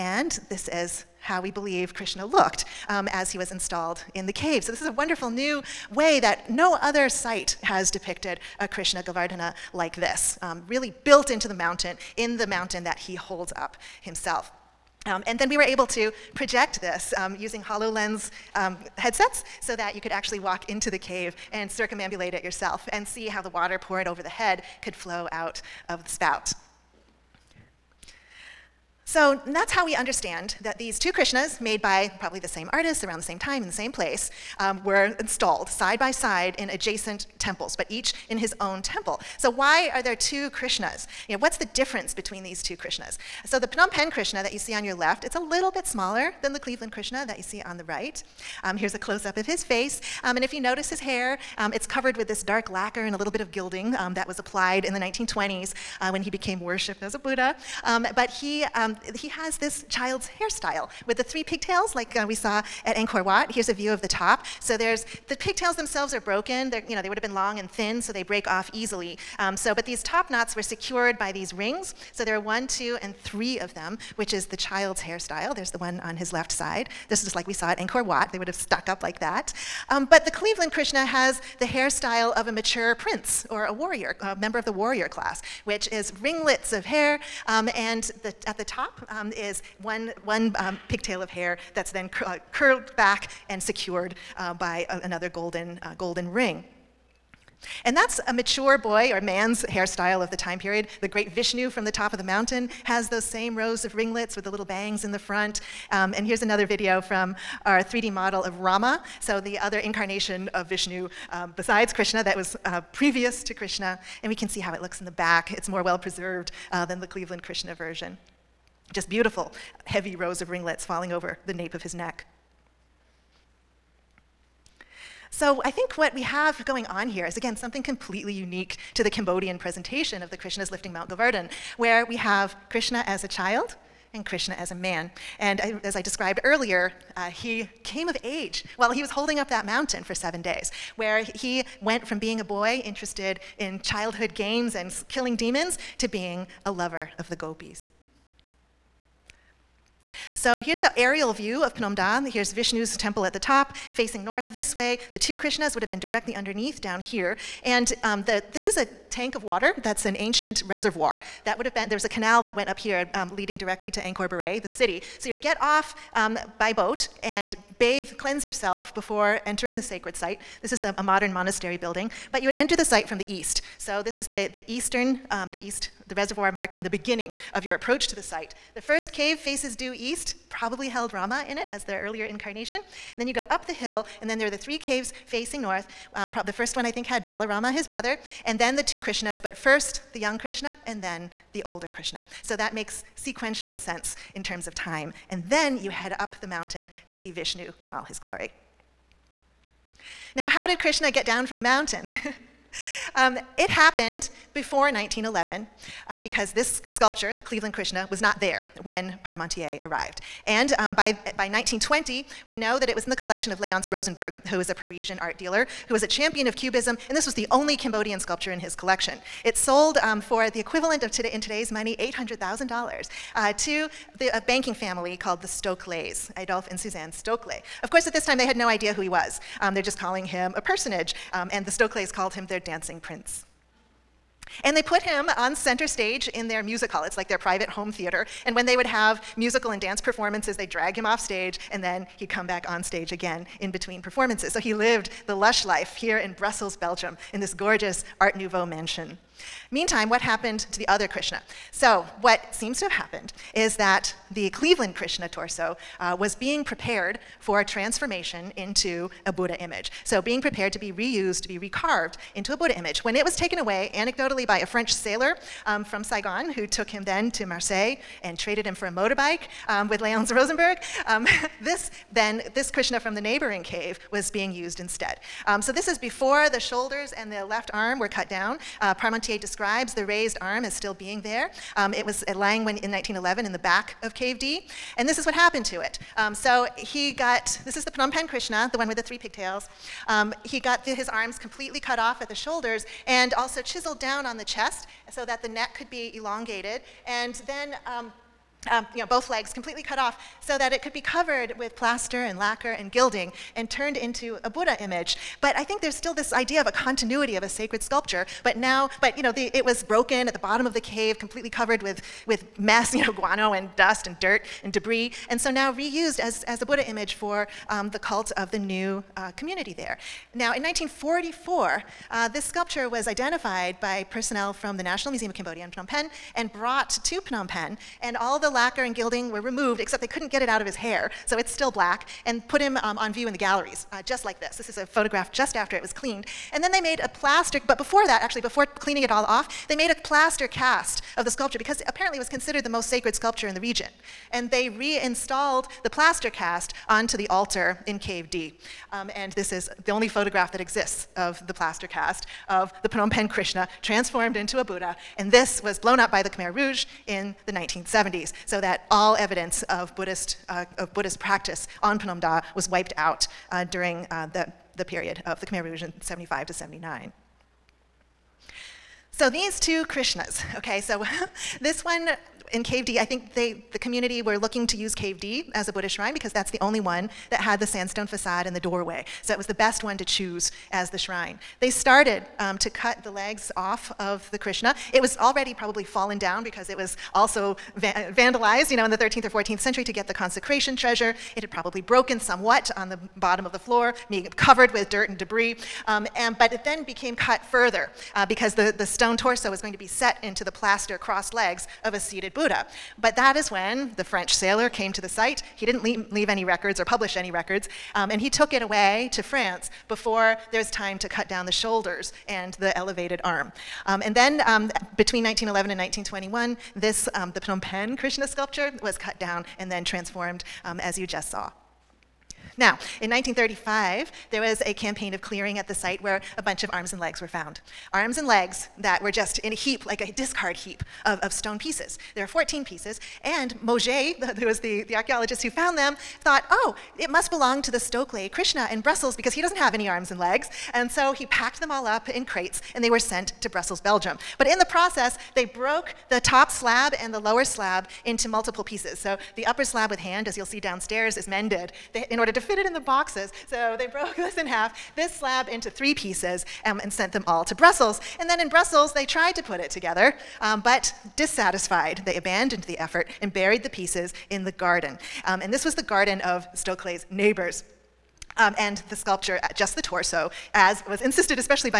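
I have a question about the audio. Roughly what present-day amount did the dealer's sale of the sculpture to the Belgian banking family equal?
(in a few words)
$800,000.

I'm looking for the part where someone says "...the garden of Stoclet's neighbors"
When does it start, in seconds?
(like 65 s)
465 s.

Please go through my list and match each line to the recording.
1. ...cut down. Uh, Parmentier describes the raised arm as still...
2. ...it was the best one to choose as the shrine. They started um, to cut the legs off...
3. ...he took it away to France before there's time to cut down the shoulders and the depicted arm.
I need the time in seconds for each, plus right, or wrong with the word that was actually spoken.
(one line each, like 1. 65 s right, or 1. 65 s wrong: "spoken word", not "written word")
1. 278 s right
2. 379 s right
3. 408 s wrong: "elevated", not "depicted".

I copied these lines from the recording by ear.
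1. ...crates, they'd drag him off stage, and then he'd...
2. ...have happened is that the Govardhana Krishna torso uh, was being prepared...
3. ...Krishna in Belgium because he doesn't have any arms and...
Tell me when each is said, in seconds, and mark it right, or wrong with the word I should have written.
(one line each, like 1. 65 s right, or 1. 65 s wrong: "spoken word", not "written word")
1. 240 s wrong: "performances", not "crates"
2. 252 s wrong: "Cleveland", not "Govardhana"
3. 438 s wrong: "Brussels", not "Belgium".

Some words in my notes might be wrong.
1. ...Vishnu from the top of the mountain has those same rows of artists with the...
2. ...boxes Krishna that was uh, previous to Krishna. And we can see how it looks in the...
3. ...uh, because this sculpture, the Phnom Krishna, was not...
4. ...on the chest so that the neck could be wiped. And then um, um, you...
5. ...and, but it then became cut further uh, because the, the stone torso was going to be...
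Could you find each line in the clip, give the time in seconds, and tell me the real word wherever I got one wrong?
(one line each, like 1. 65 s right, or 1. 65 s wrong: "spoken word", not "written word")
1. 101 s wrong: "ringlets", not "artists"
2. 111 s wrong: "besides", not "boxes"
3. 206 s wrong: "Cleveland", not "Phnom"
4. 294 s wrong: "elongated", not "wiped"
5. 396 s right.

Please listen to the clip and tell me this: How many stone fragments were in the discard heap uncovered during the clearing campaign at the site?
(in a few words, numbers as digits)
14.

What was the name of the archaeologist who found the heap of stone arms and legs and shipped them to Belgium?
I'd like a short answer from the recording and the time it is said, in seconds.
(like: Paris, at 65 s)
Mauger, at 433 s.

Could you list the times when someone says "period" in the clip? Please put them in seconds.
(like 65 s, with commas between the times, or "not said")
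100 s, 364 s.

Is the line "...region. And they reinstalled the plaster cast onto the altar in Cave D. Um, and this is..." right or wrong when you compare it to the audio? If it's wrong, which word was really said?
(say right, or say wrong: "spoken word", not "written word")
right.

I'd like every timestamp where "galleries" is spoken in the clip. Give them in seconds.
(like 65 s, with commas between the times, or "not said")
333 s.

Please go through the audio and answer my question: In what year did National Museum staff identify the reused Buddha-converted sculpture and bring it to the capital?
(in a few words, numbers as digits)
1944.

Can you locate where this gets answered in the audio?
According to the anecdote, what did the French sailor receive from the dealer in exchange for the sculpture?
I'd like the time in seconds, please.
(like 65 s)
268 s.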